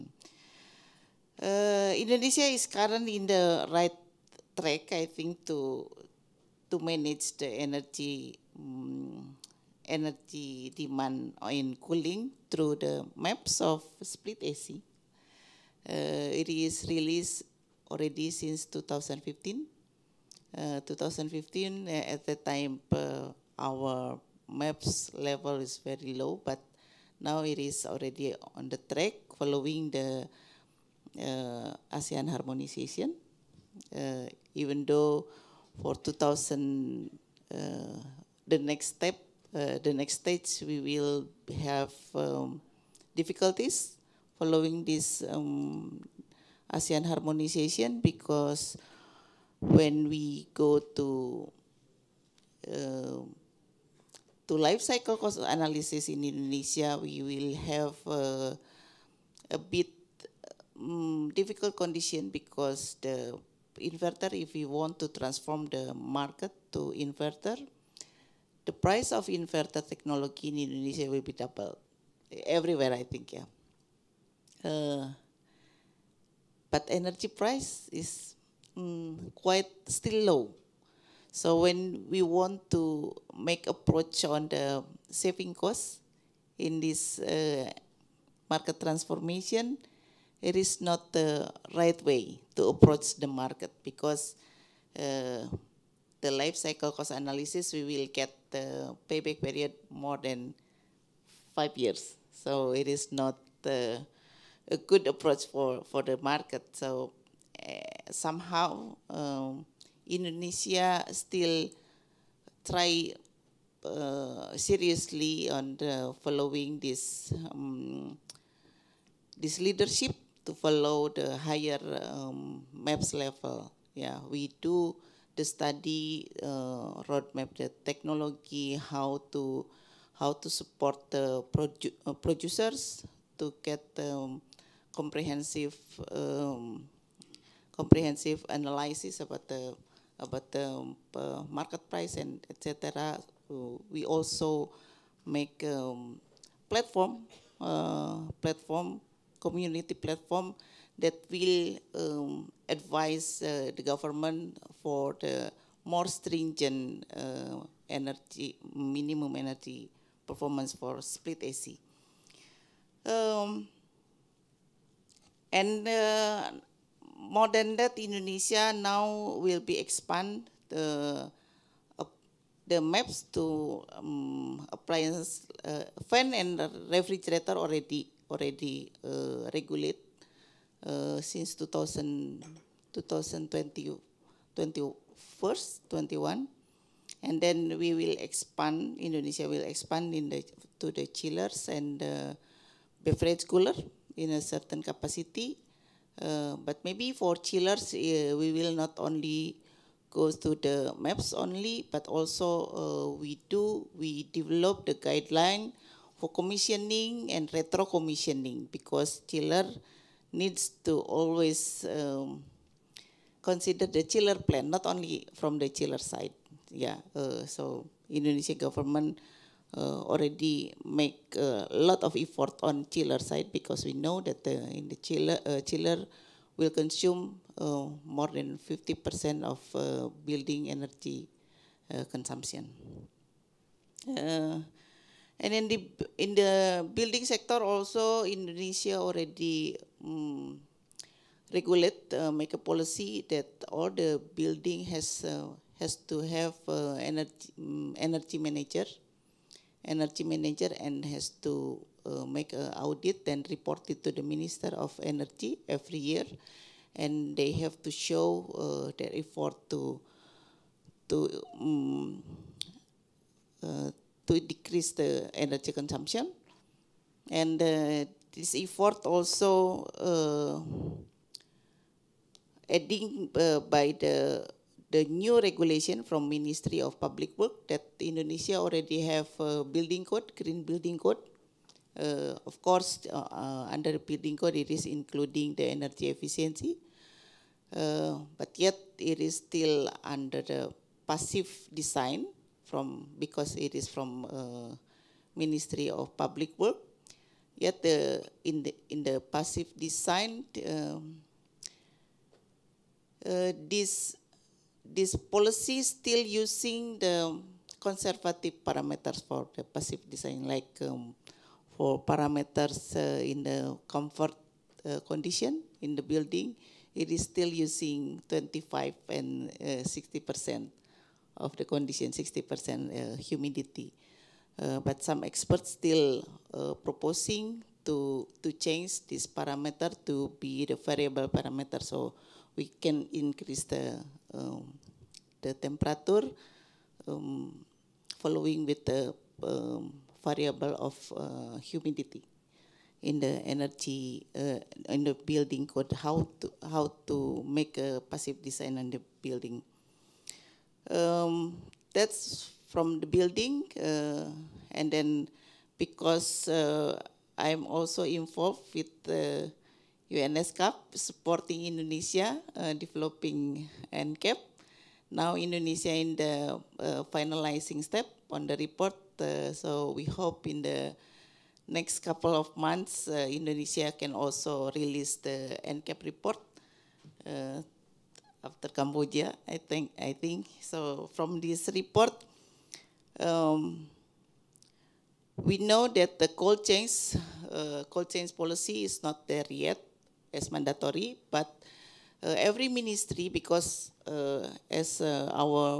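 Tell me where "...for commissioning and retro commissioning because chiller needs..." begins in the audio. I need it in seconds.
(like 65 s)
206 s.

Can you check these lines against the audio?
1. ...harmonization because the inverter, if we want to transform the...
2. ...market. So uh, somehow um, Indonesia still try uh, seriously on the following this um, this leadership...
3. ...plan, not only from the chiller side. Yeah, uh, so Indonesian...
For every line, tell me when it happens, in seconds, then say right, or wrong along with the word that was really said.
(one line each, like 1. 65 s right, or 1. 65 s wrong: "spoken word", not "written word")
1. 61 s wrong: "condition", not "harmonization"
2. 106 s right
3. 214 s right.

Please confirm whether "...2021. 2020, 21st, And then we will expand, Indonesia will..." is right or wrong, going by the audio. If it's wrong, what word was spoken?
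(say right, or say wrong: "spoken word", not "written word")
right.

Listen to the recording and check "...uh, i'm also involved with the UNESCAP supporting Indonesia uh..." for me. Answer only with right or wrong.
right.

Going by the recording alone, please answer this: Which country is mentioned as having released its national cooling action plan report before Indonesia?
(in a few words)
Cambodia.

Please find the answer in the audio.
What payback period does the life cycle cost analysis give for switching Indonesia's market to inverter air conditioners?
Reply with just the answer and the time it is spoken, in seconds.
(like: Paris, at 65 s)
More than five years, at 99 s.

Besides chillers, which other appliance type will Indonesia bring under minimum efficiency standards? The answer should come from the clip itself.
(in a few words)
Beverage cooler.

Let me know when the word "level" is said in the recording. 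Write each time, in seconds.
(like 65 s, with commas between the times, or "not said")
25 s, 123 s.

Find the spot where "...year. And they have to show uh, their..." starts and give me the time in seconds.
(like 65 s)
255 s.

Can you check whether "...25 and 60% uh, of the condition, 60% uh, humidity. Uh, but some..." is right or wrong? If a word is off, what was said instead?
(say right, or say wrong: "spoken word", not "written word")
right.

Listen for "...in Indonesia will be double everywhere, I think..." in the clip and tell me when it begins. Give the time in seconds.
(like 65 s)
70 s.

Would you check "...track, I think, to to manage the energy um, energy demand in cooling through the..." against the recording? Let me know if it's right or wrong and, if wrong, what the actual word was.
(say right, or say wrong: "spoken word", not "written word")
right.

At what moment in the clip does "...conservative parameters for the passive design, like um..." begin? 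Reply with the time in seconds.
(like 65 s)
307 s.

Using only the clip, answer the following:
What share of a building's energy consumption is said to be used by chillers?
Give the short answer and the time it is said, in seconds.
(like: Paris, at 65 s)
More than 50%, at 228 s.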